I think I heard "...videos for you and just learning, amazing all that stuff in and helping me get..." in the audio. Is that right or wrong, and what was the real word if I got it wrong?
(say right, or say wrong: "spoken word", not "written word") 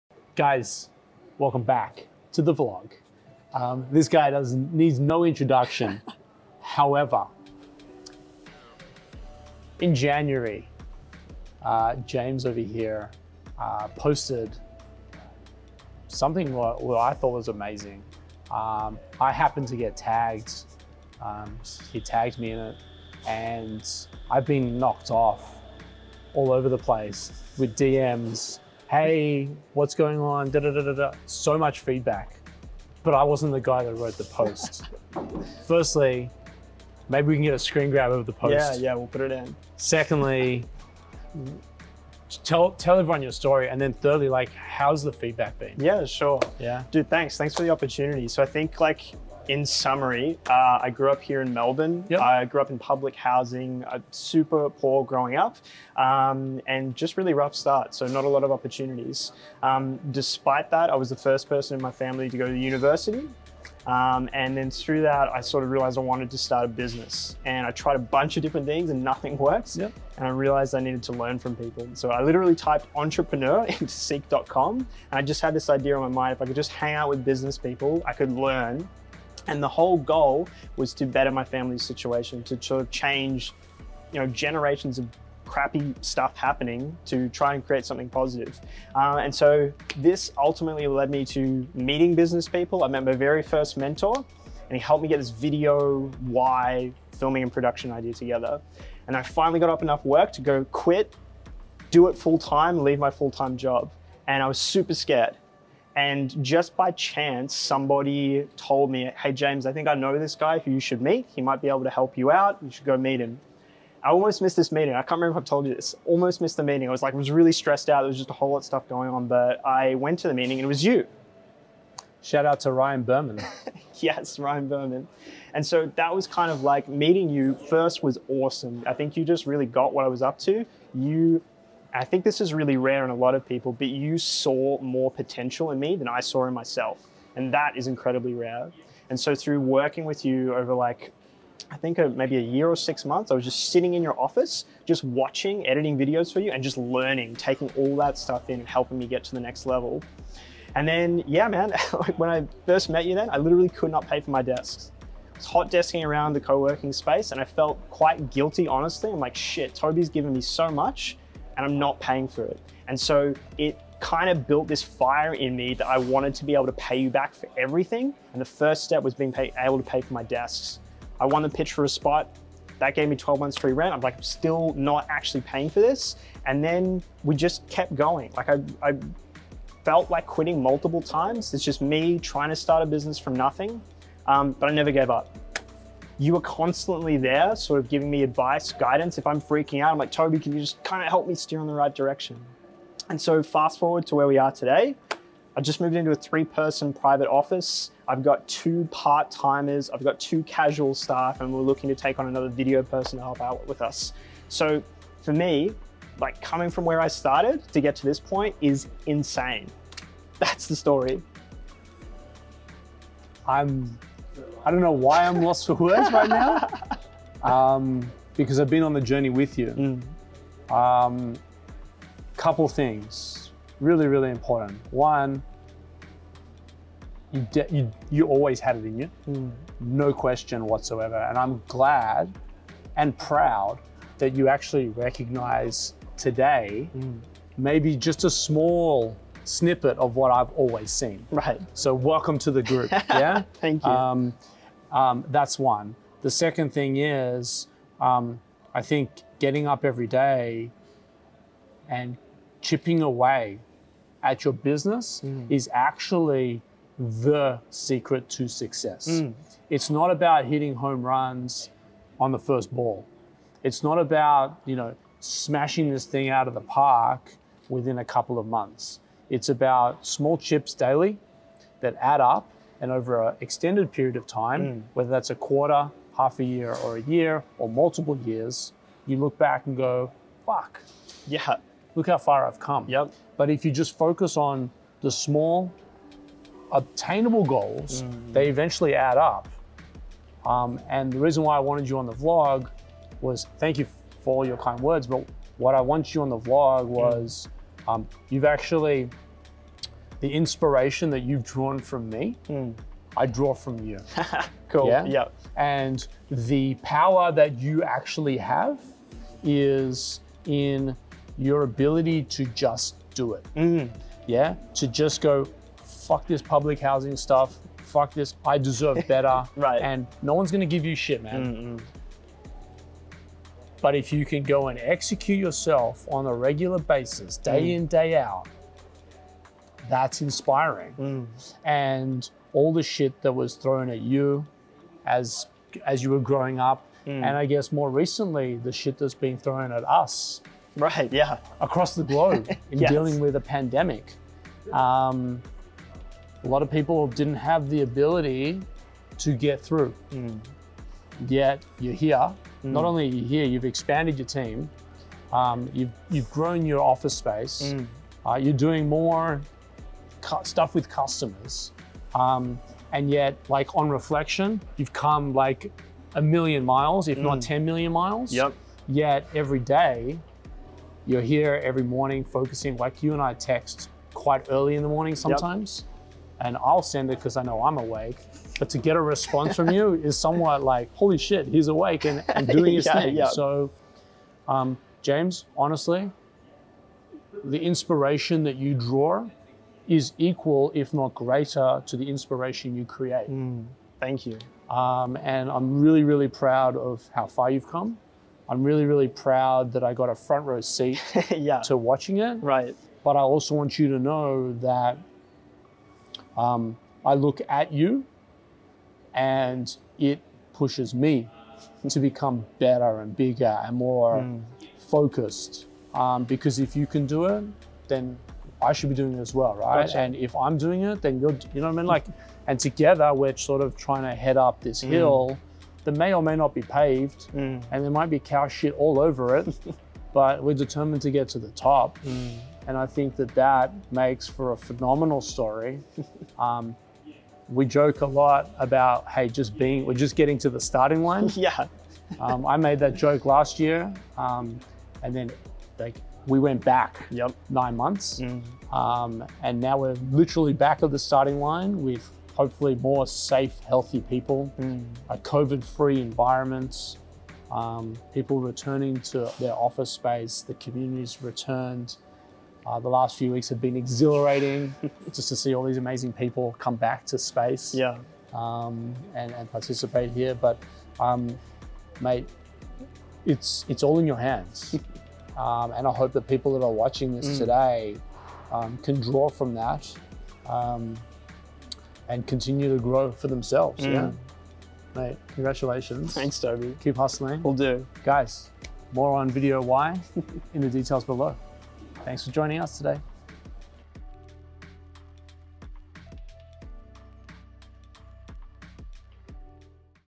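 wrong: "taking", not "amazing".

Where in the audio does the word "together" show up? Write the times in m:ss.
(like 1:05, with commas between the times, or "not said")
1:38, 7:02.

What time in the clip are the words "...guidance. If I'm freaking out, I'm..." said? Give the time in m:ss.
3:08.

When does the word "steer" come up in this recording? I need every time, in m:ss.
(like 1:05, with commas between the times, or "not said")
3:11.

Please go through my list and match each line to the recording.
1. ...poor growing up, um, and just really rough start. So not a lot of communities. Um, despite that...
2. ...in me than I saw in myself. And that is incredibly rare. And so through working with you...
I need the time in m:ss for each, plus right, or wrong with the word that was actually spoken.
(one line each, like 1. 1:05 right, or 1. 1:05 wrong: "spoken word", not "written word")
1. 0:54 wrong: "opportunities", not "communities"
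2. 2:15 right.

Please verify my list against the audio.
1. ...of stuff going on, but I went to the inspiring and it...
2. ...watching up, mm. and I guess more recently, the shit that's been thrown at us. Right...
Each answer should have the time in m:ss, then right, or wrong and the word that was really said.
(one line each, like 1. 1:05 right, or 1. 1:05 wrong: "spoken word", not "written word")
1. 1:58 wrong: "meeting", not "inspiring"
2. 5:36 wrong: "growing", not "watching".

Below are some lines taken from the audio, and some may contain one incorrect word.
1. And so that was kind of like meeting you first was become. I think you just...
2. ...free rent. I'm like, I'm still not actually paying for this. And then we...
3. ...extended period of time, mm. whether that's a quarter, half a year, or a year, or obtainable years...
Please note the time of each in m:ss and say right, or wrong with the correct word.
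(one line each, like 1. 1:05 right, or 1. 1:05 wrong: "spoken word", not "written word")
1. 2:05 wrong: "awesome", not "become"
2. 2:53 right
3. 4:33 wrong: "multiple", not "obtainable".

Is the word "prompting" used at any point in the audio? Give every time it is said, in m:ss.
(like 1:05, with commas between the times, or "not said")
not said.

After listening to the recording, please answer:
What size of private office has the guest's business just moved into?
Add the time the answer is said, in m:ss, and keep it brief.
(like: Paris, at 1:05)
three person, at 3:16.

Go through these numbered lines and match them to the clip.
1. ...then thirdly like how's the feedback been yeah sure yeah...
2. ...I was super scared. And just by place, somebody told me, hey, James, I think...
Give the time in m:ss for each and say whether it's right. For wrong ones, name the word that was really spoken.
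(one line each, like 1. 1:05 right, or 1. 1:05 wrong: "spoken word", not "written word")
1. 0:43 right
2. 1:44 wrong: "chance", not "place".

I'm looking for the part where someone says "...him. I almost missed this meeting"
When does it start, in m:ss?
1:53.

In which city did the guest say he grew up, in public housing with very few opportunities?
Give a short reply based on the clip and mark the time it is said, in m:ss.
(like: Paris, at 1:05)
Melbourne, at 0:51.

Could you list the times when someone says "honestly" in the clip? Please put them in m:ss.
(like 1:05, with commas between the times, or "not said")
2:38, 6:25.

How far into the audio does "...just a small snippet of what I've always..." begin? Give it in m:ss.
3:57.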